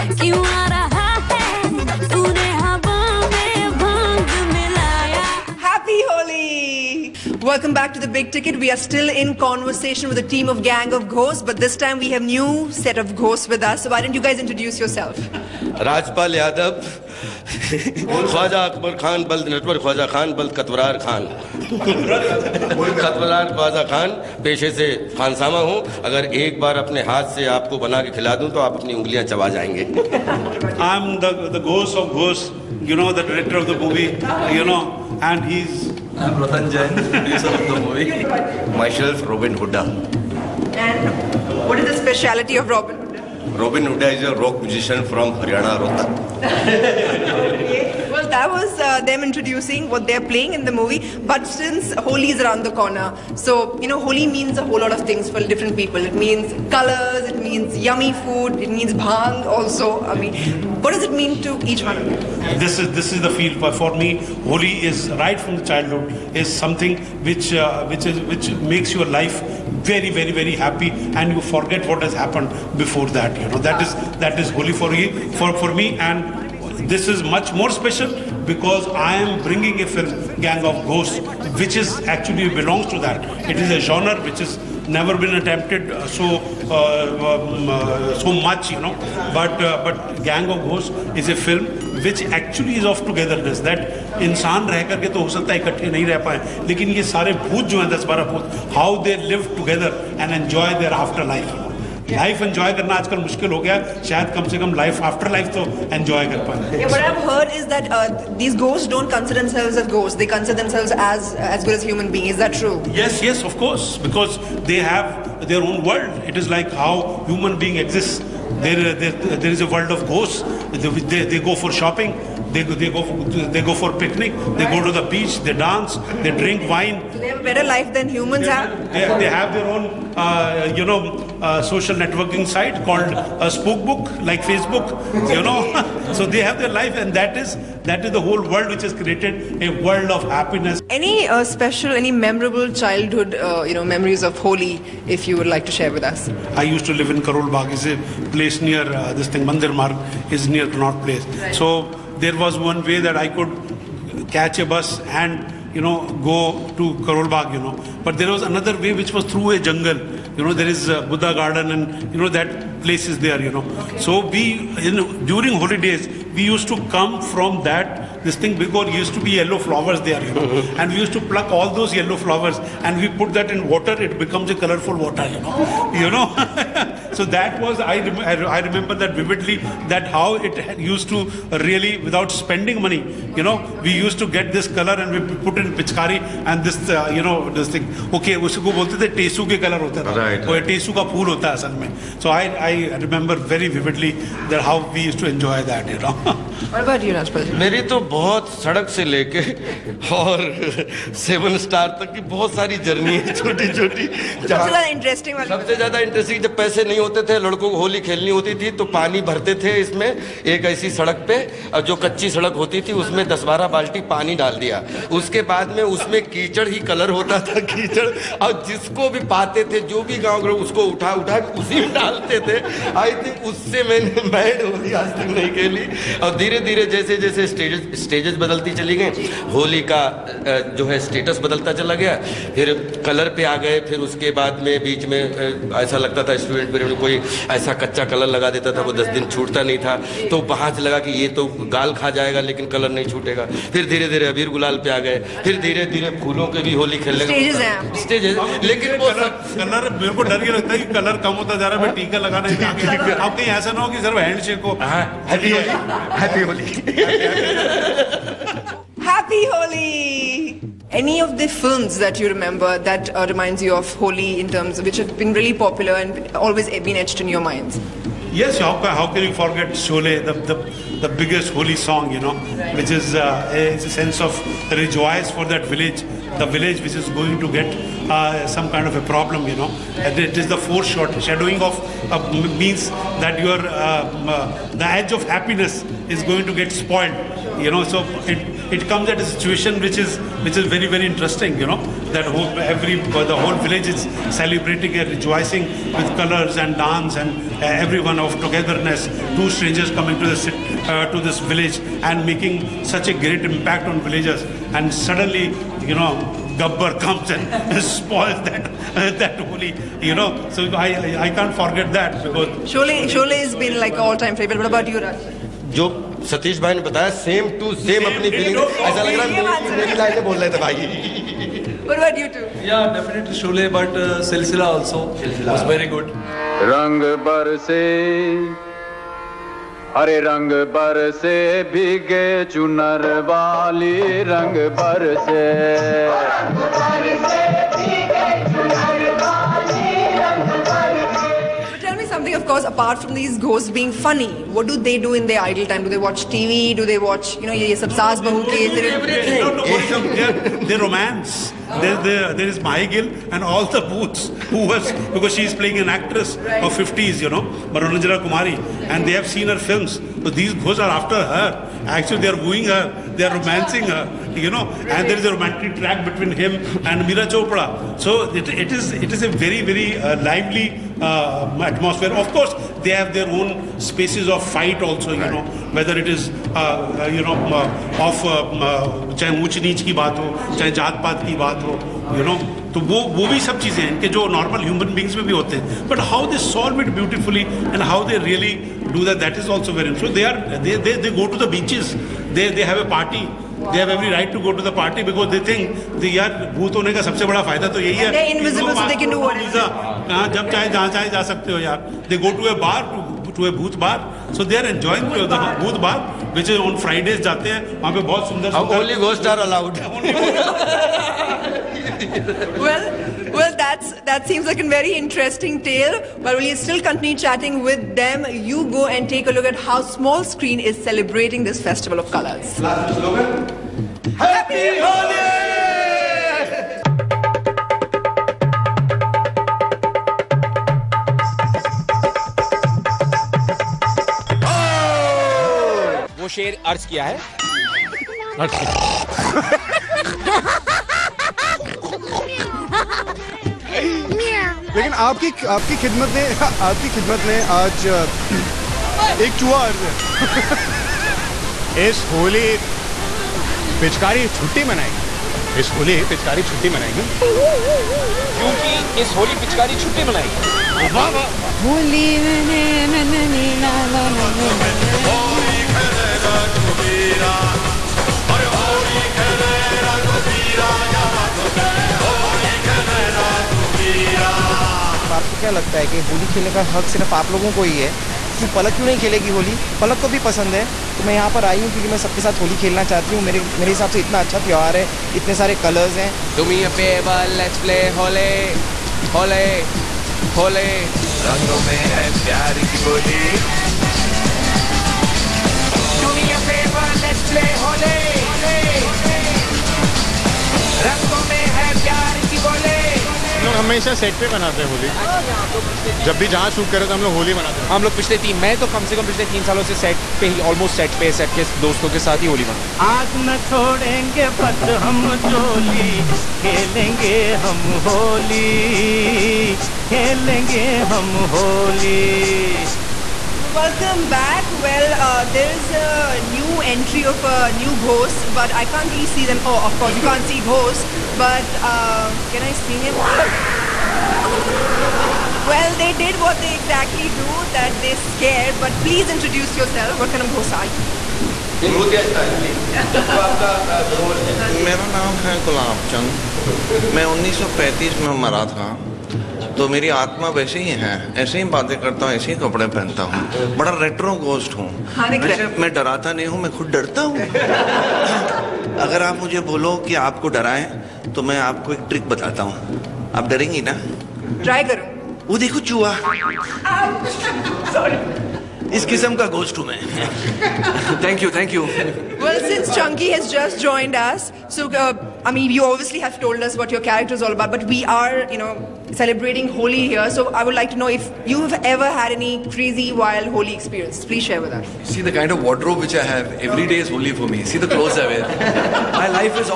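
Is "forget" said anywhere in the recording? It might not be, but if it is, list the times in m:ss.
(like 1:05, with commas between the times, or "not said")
1:11, 4:29, 5:11.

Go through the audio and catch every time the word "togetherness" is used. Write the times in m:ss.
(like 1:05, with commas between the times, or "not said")
1:33, 4:58.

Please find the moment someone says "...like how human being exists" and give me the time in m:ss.
1:56.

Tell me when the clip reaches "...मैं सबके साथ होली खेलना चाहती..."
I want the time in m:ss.
8:01.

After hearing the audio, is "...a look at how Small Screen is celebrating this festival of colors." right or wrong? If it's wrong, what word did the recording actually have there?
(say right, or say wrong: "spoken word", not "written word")
right.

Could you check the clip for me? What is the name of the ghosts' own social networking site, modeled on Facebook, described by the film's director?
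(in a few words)
Spookbook.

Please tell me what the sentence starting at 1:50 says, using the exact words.
They consider themselves as as good as human beings.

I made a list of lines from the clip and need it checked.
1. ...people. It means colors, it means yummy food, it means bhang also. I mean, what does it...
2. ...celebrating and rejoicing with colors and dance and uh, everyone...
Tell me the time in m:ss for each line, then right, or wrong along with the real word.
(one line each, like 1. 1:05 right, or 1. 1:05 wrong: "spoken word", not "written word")
1. 0:55 right
2. 4:54 right.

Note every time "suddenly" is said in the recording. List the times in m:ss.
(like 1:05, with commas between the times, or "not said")
5:04.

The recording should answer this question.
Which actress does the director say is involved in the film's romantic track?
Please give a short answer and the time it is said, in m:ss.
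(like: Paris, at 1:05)
Meera Chopra, at 6:07.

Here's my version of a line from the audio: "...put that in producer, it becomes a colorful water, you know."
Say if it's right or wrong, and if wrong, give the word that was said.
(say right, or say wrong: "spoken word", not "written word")
wrong: "water", not "producer".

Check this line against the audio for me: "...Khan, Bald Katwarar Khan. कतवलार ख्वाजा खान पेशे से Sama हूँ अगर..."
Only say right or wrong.
right.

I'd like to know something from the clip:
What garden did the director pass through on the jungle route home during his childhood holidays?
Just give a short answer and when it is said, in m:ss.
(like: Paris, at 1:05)
Buddha garden, at 2:41.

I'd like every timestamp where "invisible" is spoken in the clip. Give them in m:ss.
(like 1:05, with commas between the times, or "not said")
6:38.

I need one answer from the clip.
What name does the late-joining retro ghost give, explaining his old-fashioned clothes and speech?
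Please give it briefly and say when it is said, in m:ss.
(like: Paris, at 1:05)
1935, at 9:05.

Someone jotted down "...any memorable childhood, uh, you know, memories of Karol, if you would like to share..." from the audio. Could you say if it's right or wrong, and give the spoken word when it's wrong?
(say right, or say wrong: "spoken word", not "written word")
wrong: "Holi", not "Karol".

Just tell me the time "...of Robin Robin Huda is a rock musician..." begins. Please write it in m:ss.
0:42.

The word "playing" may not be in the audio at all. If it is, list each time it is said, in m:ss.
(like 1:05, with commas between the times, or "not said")
0:50, 5:55.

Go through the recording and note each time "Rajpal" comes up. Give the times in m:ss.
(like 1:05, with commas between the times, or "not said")
0:15, 3:17.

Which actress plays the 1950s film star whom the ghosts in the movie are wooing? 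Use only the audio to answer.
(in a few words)
Mahi Gill.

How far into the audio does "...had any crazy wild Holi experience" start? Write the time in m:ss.
9:41.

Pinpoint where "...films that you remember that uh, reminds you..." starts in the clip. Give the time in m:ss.
4:21.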